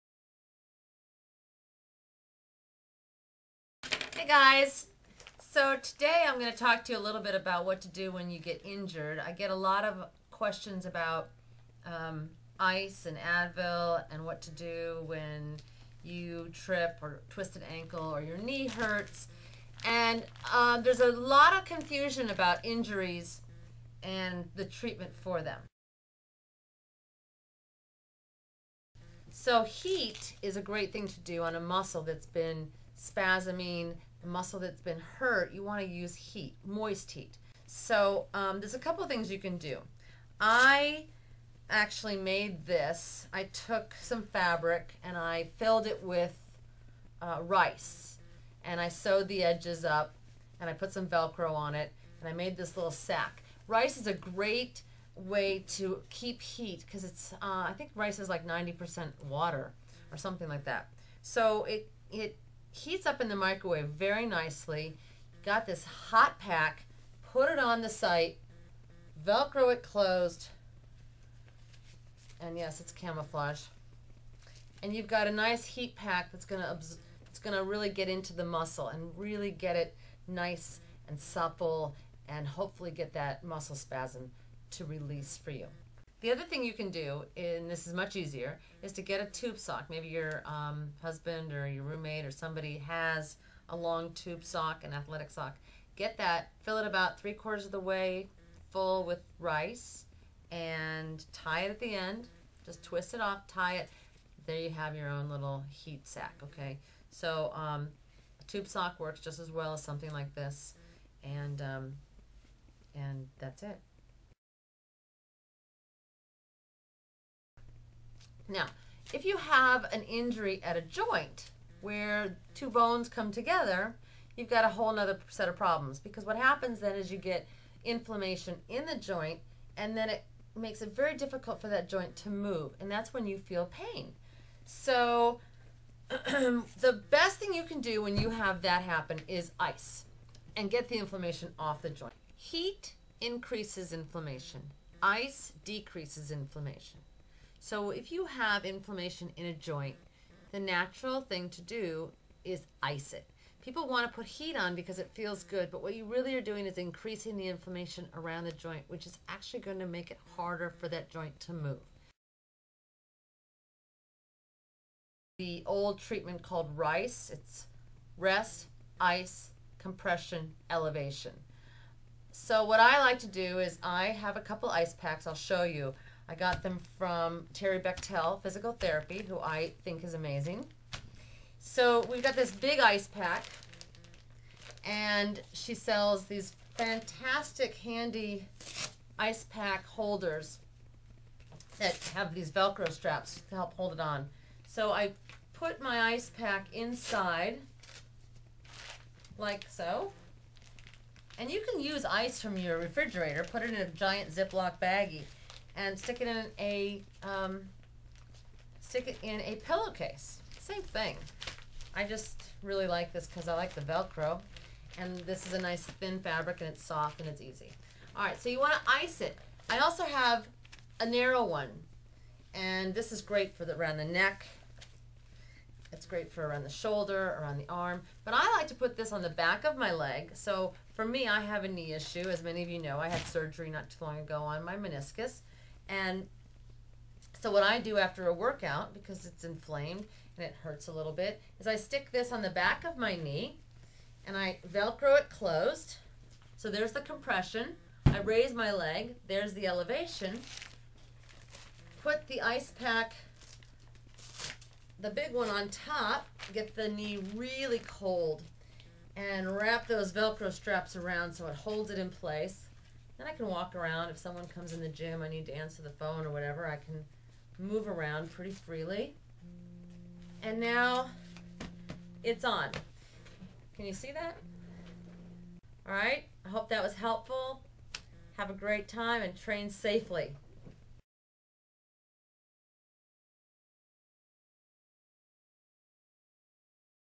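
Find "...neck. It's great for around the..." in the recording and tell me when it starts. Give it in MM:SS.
03:44.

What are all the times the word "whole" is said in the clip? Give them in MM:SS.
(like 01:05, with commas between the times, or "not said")
02:04.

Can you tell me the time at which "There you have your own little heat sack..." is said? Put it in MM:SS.
01:44.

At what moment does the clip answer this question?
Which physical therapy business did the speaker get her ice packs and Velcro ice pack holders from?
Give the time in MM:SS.
02:57.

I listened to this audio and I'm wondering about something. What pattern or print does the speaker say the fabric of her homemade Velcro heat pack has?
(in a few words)
camouflage.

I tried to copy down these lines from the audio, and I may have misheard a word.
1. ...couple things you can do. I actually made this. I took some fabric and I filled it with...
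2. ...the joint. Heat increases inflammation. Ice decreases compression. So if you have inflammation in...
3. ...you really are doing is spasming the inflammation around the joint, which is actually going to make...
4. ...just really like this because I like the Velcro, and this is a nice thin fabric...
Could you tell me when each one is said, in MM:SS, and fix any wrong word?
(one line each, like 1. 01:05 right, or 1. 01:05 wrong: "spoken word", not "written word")
1. 00:38 right
2. 02:21 wrong: "inflammation", not "compression"
3. 02:35 wrong: "increasing", not "spasming"
4. 03:32 right.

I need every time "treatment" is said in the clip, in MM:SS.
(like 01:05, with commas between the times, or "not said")
00:24, 02:45.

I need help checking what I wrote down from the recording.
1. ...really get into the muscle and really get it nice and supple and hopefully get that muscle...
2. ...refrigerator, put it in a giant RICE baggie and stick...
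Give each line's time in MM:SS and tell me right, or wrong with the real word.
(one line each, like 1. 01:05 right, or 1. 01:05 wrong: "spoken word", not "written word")
1. 01:17 right
2. 03:22 wrong: "Ziploc", not "RICE".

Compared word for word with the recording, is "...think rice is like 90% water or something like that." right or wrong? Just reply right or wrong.
right.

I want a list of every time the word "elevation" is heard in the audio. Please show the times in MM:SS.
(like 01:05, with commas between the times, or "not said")
02:50, 04:09.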